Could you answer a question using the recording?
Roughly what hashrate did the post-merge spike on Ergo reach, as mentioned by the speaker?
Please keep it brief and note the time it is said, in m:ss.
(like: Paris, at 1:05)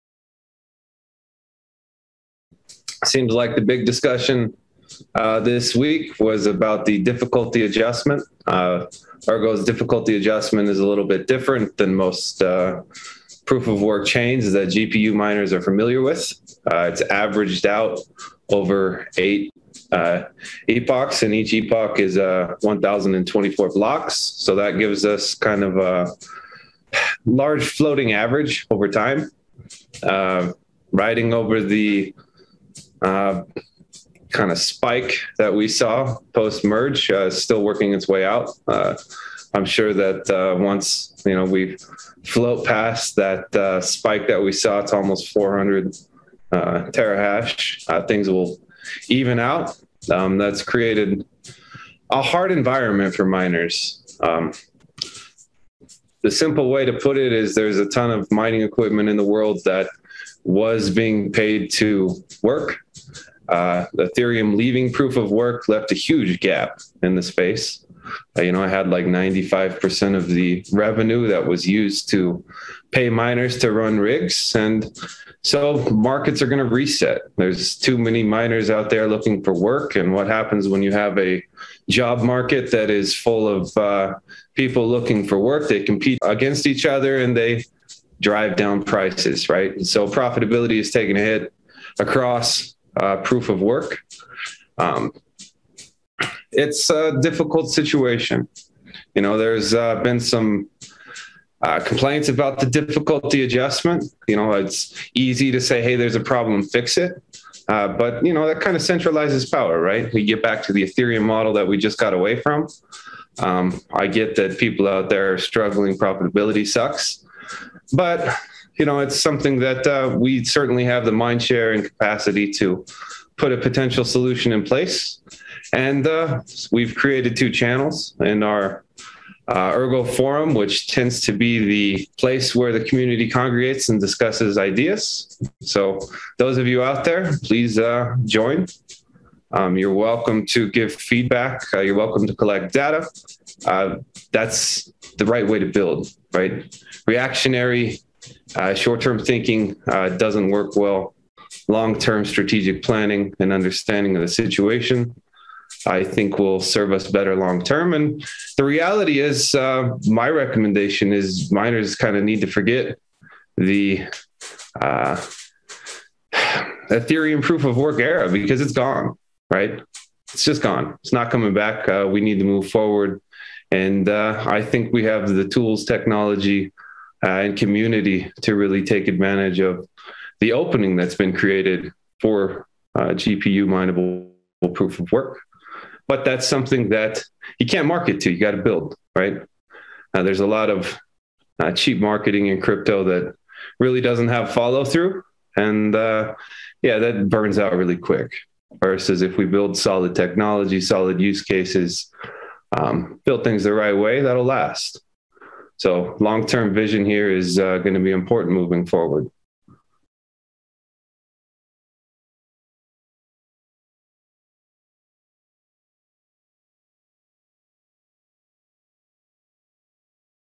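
almost 400 terahash, at 0:45.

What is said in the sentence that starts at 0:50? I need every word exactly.
Um, that's created a hard environment for miners.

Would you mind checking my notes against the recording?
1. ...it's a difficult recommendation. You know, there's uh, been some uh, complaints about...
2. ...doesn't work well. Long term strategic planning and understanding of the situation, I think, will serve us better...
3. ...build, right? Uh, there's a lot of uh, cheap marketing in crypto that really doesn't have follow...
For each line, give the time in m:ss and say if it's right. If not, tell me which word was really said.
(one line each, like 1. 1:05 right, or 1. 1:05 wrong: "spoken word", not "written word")
1. 1:36 wrong: "situation", not "recommendation"
2. 2:30 right
3. 3:08 right.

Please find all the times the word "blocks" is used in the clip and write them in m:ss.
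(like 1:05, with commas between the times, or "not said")
0:23.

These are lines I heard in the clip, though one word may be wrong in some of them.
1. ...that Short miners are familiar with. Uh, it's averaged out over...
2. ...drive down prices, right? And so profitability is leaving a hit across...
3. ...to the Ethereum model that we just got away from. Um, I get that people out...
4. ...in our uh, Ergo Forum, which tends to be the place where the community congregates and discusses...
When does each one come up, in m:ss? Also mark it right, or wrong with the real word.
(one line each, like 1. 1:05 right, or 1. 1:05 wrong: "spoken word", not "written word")
1. 0:14 wrong: "GPU", not "Short"
2. 1:28 wrong: "taking", not "leaving"
3. 1:50 right
4. 2:08 right.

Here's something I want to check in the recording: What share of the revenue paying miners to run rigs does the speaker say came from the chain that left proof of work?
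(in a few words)
95%.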